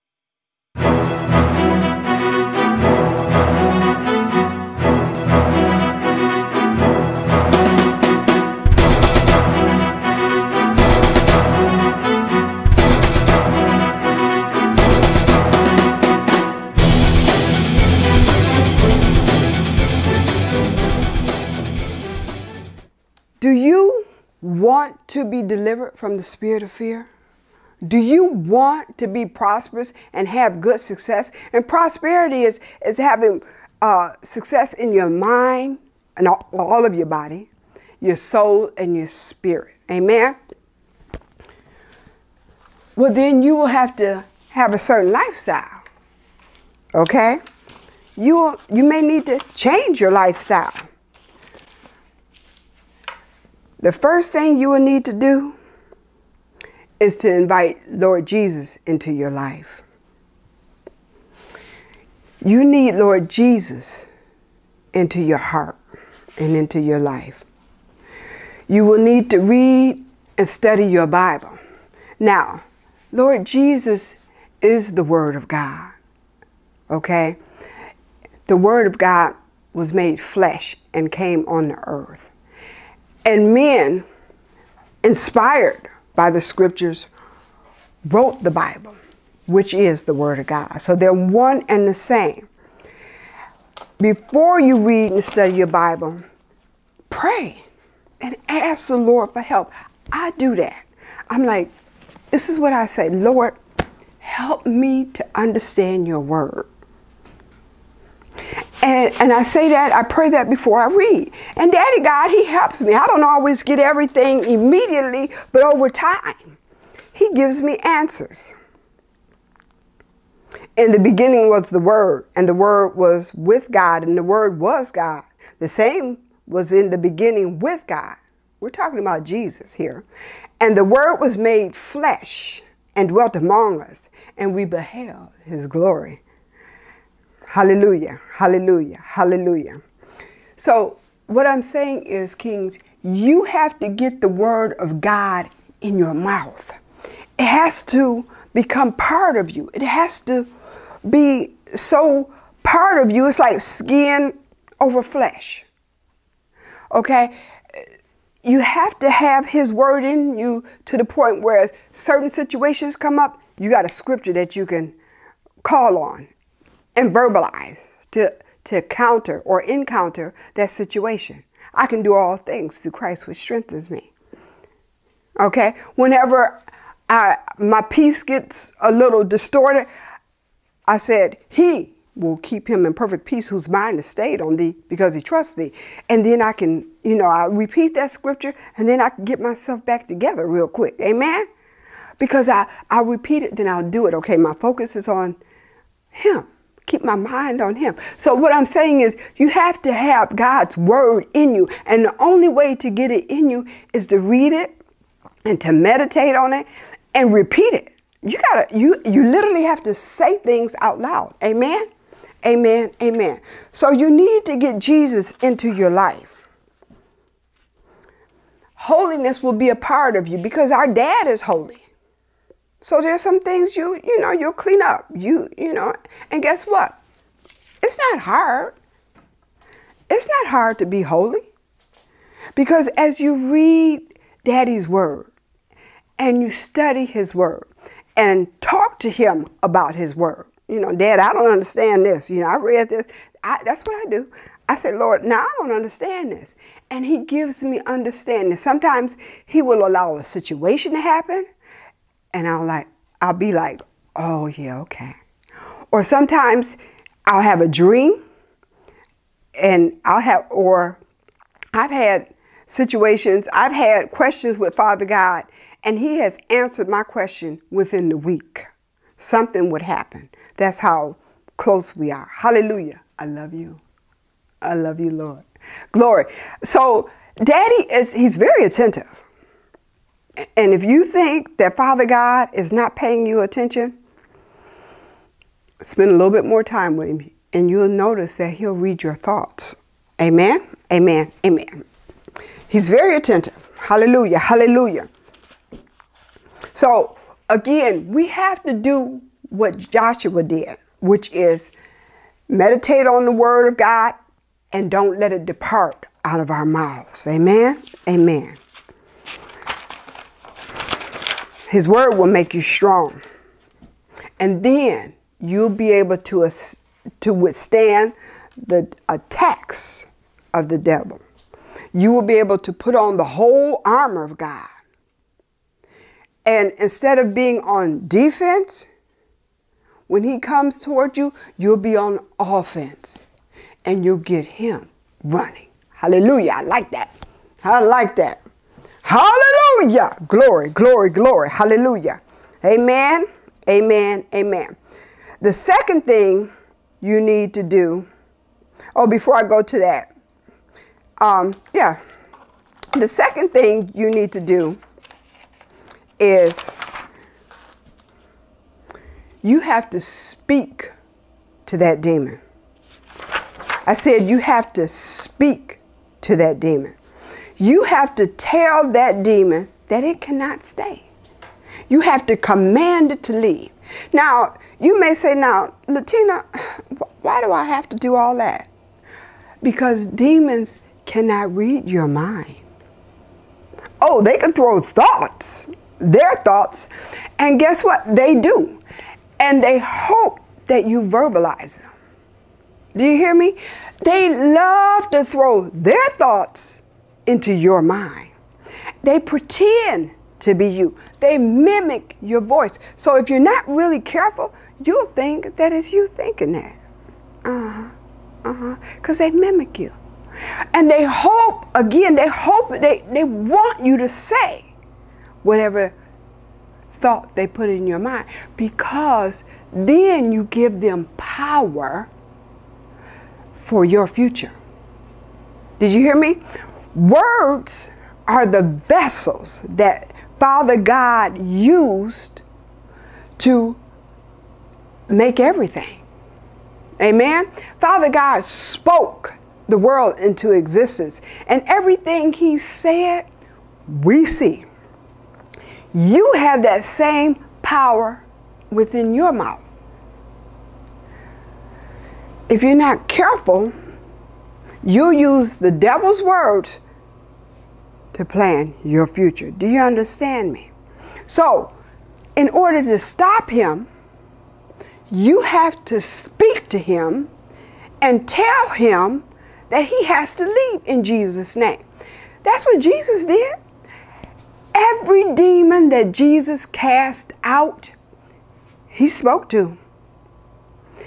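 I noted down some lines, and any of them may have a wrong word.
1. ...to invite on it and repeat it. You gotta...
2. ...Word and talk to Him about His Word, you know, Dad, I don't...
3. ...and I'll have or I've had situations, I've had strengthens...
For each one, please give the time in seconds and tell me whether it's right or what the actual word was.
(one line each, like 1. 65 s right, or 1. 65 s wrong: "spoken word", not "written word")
1. 205 s wrong: "meditate", not "invite"
2. 237 s right
3. 259 s wrong: "questions", not "strengthens".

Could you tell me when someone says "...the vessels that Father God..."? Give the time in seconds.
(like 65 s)
428 s.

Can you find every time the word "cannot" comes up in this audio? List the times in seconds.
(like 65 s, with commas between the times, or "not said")
370 s, 381 s.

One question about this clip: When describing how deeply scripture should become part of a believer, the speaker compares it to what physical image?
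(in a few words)
Skin over flesh.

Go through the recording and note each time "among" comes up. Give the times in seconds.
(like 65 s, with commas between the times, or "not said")
133 s.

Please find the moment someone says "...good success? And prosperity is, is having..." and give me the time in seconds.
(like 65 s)
30 s.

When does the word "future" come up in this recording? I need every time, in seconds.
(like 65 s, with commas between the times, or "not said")
424 s, 459 s.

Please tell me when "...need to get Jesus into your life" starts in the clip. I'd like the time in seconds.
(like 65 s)
214 s.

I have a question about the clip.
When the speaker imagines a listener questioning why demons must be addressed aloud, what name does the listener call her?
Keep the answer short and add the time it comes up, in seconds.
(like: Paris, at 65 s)
Latina, at 375 s.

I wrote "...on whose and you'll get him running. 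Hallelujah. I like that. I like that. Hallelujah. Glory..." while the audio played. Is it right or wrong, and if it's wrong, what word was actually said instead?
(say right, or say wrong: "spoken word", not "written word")
wrong: "offense", not "whose".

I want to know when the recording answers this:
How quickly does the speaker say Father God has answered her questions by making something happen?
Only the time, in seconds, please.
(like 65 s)
267 s.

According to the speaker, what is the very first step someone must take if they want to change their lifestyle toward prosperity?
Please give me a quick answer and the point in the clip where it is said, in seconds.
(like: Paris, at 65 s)
Invite Lord Jesus into your life, at 57 s.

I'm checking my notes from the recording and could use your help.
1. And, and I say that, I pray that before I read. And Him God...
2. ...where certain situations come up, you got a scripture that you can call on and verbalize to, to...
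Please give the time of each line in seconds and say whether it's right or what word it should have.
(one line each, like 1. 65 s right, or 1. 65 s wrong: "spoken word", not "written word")
1. 108 s wrong: "Daddy", not "Him"
2. 161 s right.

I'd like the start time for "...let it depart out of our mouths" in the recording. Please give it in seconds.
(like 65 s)
305 s.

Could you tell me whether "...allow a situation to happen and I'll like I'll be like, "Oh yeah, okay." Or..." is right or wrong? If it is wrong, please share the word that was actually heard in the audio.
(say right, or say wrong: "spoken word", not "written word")
right.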